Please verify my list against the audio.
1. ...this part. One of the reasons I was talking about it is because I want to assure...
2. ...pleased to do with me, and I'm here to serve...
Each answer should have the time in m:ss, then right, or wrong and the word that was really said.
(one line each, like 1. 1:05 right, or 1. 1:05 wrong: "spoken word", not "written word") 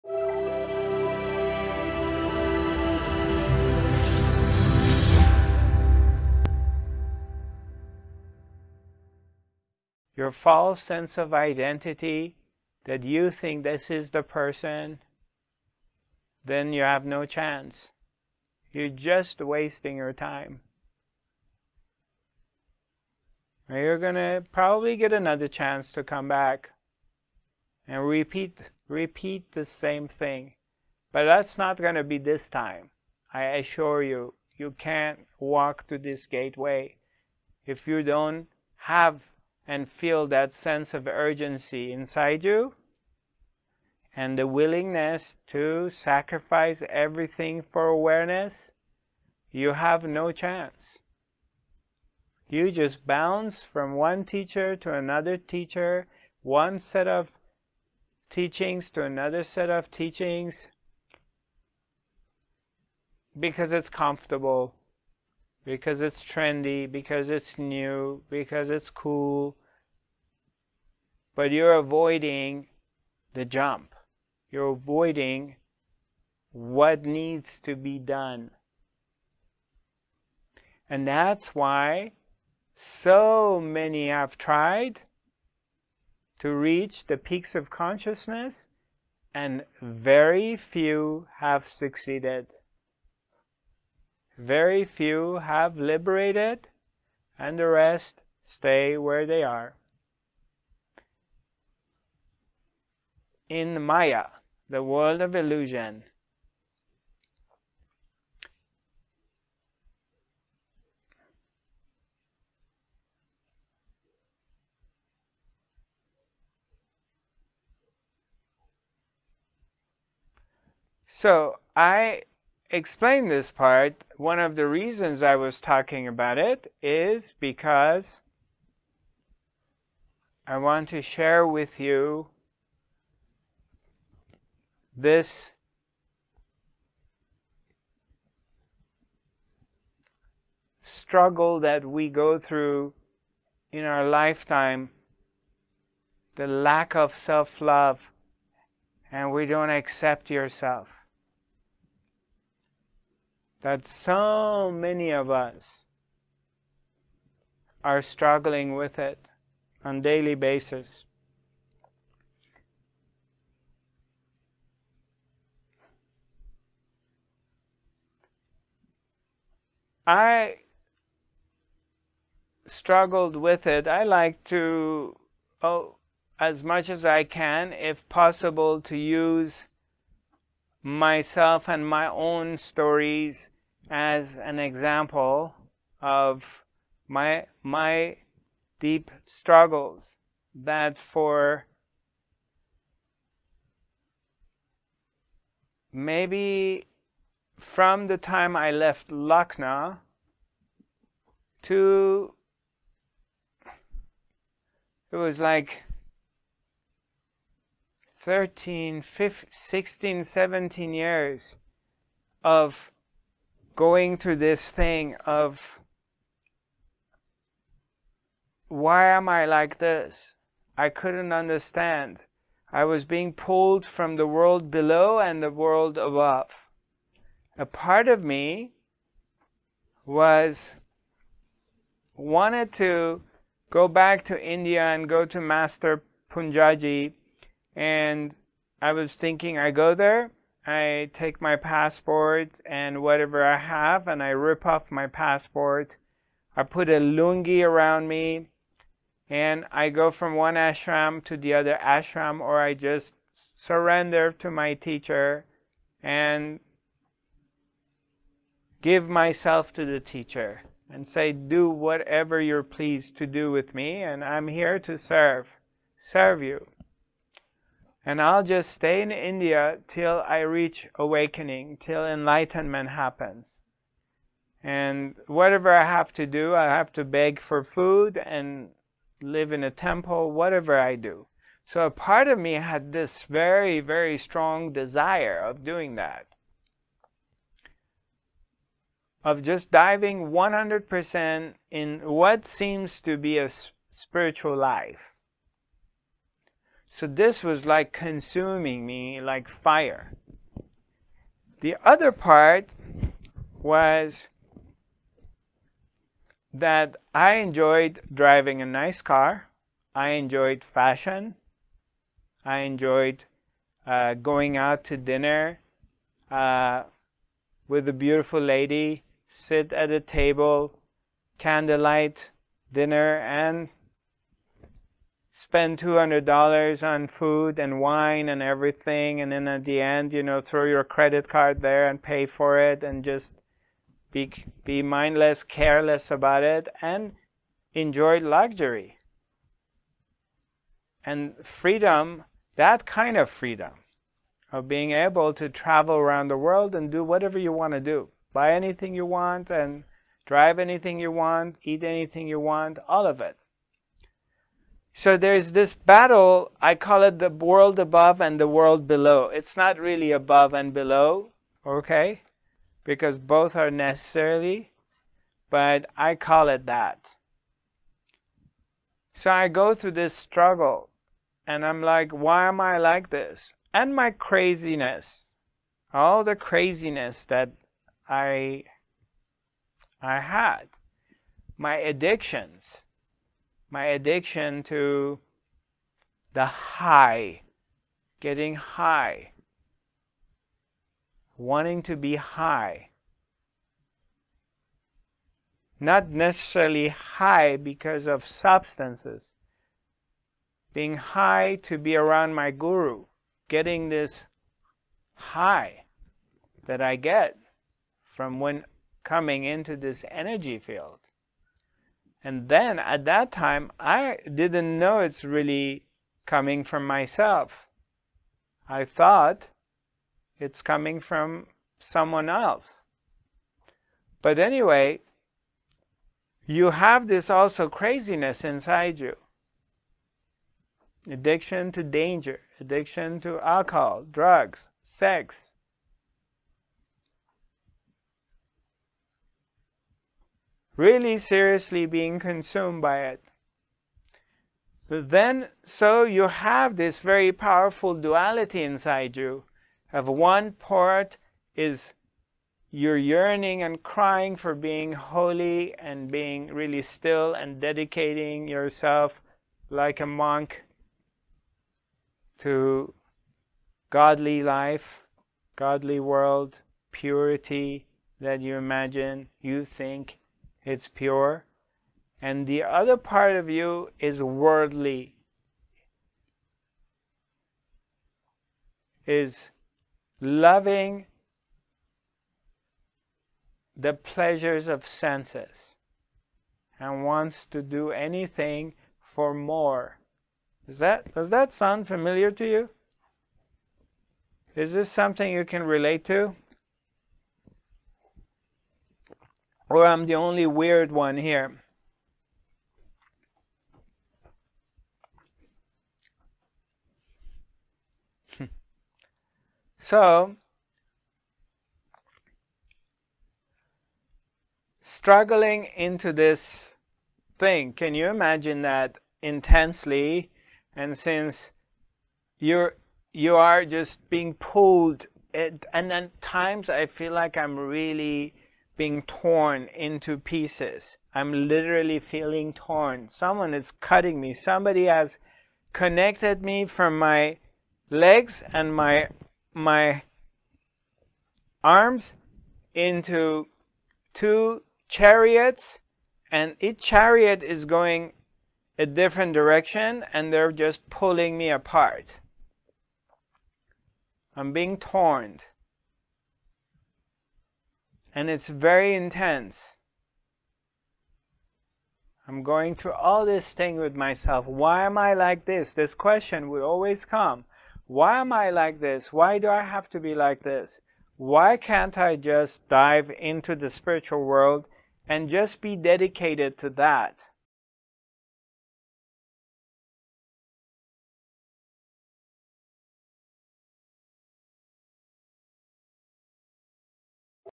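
1. 2:03 wrong: "share", not "assure"
2. 4:22 right.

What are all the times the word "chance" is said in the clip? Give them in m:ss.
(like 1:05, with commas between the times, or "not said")
0:17, 0:25, 0:50.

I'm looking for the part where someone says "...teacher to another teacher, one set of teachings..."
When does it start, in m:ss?
0:54.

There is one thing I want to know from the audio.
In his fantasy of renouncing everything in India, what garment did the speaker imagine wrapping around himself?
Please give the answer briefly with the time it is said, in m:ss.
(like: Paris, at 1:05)
lungi, at 4:06.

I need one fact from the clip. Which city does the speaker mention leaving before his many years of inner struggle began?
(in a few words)
Lucknow.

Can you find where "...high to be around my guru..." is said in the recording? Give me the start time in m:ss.
6:40.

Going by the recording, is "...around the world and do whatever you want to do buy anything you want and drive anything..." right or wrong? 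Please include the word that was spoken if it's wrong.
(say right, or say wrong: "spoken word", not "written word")
right.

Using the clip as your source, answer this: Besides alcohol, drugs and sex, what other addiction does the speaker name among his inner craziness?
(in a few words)
danger.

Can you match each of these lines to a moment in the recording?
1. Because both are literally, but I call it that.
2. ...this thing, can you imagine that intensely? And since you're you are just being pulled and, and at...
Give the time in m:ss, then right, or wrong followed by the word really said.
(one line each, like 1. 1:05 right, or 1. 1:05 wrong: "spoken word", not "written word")
1. 6:02 wrong: "necessarily", not "literally"
2. 8:36 right.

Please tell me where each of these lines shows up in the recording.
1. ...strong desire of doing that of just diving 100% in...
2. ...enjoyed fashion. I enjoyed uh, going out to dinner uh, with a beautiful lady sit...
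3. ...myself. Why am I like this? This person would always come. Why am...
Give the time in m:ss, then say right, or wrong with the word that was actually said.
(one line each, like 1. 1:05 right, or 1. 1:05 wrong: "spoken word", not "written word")
1. 4:44 right
2. 5:10 right
3. 9:23 wrong: "question", not "person".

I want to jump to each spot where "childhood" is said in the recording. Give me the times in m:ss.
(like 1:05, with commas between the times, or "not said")
not said.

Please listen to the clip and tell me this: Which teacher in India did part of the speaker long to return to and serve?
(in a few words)
Master Poonjaji.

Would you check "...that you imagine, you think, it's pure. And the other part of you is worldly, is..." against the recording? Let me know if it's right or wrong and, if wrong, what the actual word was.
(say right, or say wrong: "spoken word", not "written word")
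right.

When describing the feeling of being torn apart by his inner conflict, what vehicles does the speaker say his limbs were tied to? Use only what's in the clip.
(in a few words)
two chariots.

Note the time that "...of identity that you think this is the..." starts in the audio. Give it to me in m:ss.
0:11.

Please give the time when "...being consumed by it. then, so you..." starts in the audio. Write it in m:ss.
7:21.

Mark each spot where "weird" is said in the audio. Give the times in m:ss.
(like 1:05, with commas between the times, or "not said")
8:20.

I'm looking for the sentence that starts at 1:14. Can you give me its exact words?
You're avoiding what needs to be done.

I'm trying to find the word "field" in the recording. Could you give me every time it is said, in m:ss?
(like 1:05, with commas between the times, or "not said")
6:50.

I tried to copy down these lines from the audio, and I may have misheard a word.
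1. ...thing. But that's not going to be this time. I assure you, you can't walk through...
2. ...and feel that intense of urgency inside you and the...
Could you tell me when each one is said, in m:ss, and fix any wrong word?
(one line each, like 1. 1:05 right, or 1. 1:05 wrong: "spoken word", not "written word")
1. 0:30 right
2. 0:39 wrong: "sense", not "intense".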